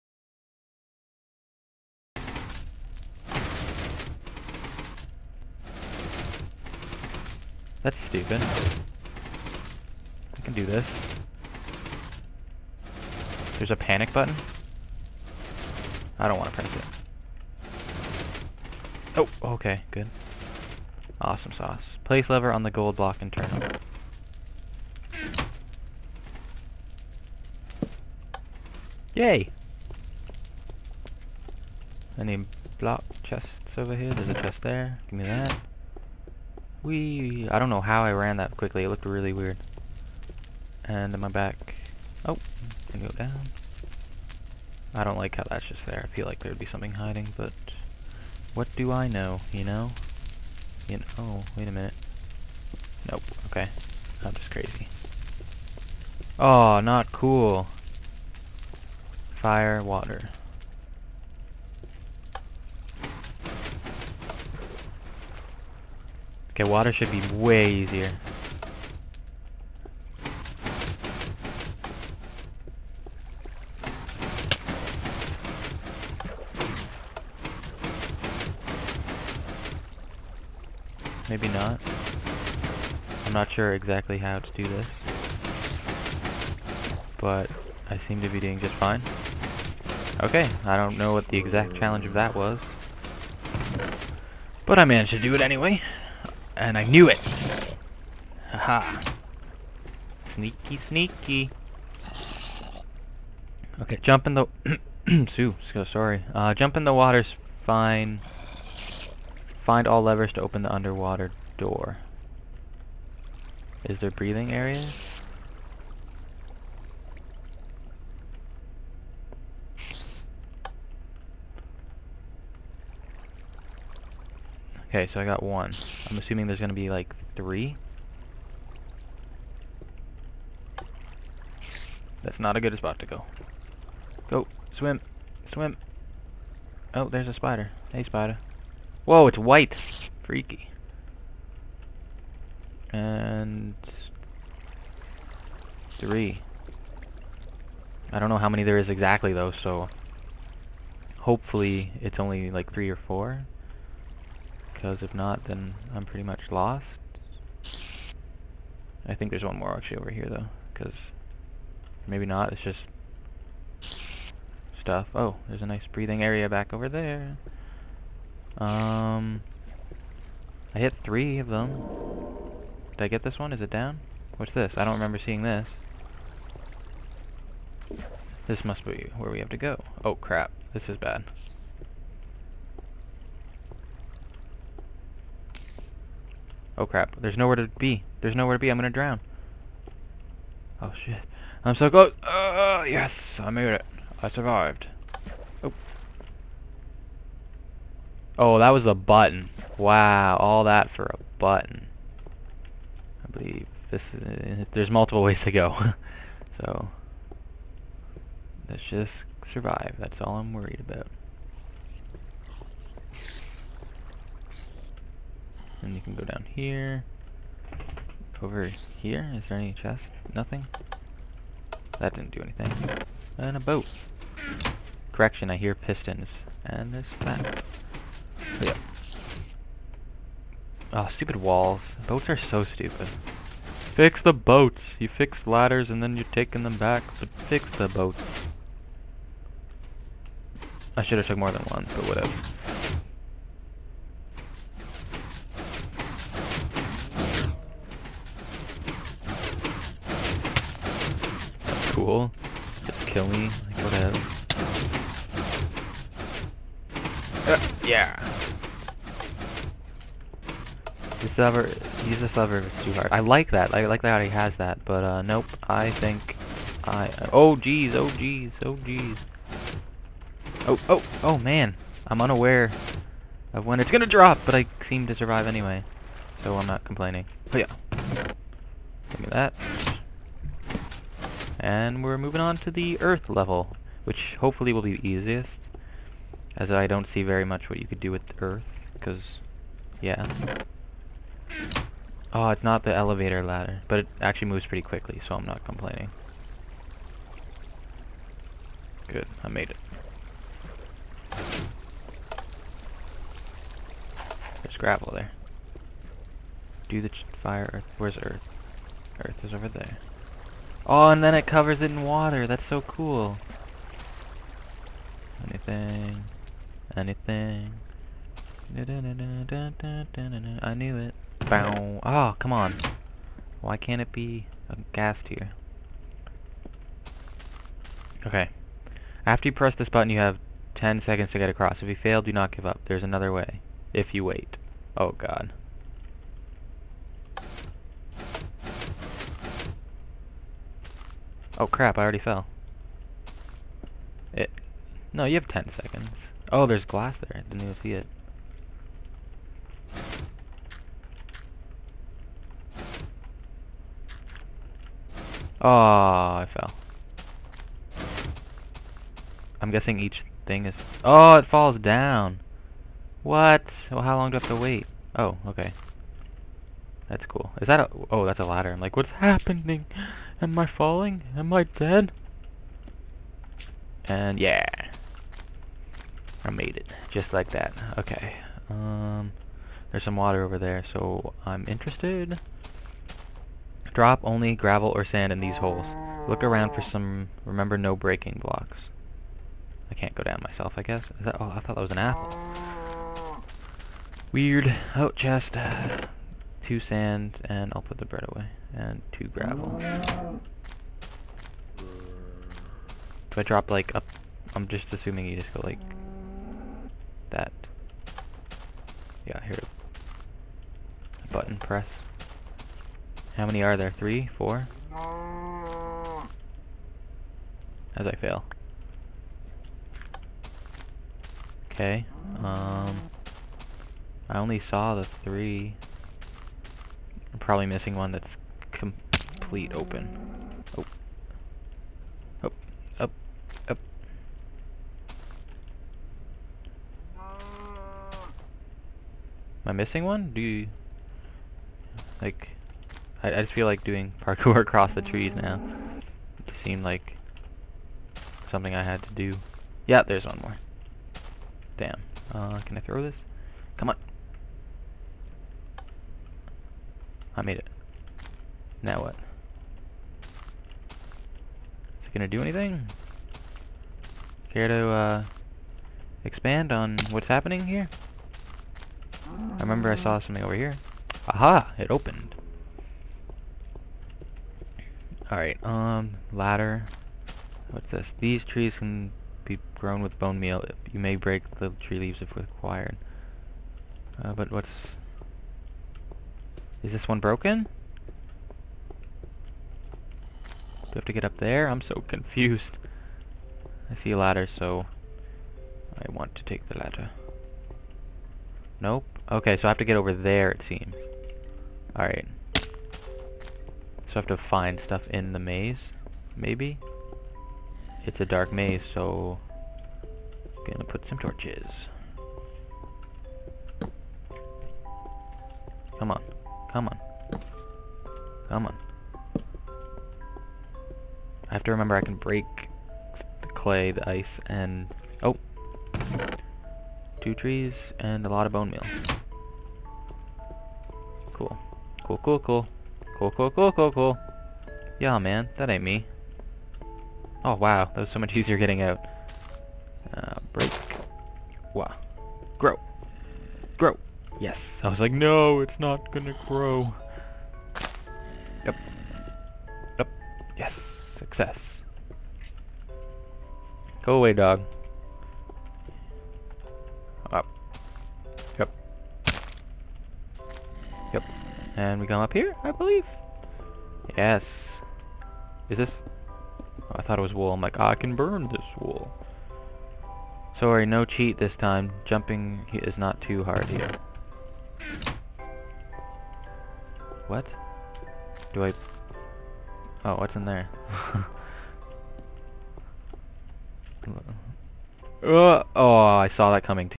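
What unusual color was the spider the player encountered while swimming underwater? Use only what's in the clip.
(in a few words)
white.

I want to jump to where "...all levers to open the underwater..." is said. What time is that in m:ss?
1:49.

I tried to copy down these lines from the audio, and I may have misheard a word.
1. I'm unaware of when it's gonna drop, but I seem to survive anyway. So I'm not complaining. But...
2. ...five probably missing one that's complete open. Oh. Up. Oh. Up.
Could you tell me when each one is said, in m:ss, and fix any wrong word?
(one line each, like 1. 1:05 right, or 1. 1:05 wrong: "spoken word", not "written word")
1. 4:32 right
2. 7:05 wrong: "three", not "five".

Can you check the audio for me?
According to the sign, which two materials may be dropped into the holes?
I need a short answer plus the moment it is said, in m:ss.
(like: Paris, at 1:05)
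gravel or sand, at 6:24.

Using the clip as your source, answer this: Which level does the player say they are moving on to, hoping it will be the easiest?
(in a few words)
earth level.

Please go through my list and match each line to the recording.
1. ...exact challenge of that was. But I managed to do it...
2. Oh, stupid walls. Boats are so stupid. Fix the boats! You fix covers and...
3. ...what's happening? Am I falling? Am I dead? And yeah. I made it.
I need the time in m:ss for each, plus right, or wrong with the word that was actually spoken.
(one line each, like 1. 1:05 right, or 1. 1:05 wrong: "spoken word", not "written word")
1. 1:31 right
2. 3:50 wrong: "ladders", not "covers"
3. 6:08 right.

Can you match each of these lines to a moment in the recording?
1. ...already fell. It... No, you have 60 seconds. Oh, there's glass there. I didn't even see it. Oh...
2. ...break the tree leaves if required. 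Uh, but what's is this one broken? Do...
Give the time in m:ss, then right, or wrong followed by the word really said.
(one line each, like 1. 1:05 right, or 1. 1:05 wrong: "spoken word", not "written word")
1. 5:42 wrong: "10", not "60"
2. 8:01 right.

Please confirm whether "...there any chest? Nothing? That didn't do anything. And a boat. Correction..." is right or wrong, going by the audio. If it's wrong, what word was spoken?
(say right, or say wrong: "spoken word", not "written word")
right.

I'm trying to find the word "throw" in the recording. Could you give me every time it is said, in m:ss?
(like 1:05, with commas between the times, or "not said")
7:32.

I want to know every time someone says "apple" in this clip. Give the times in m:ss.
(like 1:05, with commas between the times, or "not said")
6:31.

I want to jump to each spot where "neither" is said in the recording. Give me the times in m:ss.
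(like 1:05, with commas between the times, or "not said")
not said.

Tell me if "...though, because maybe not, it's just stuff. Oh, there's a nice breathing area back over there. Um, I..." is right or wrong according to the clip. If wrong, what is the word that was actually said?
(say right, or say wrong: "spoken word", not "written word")
right.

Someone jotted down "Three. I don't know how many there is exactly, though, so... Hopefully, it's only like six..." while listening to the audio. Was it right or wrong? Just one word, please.
wrong.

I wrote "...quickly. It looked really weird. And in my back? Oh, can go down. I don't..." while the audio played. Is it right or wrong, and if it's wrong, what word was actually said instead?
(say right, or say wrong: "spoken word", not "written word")
right.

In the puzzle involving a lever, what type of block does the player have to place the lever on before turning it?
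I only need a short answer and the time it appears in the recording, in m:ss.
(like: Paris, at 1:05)
gold block, at 0:22.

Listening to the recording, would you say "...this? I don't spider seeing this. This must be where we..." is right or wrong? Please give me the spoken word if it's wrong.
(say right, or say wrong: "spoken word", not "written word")
wrong: "remember", not "spider".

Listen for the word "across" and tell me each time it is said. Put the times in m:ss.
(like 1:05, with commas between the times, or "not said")
5:31, 7:24.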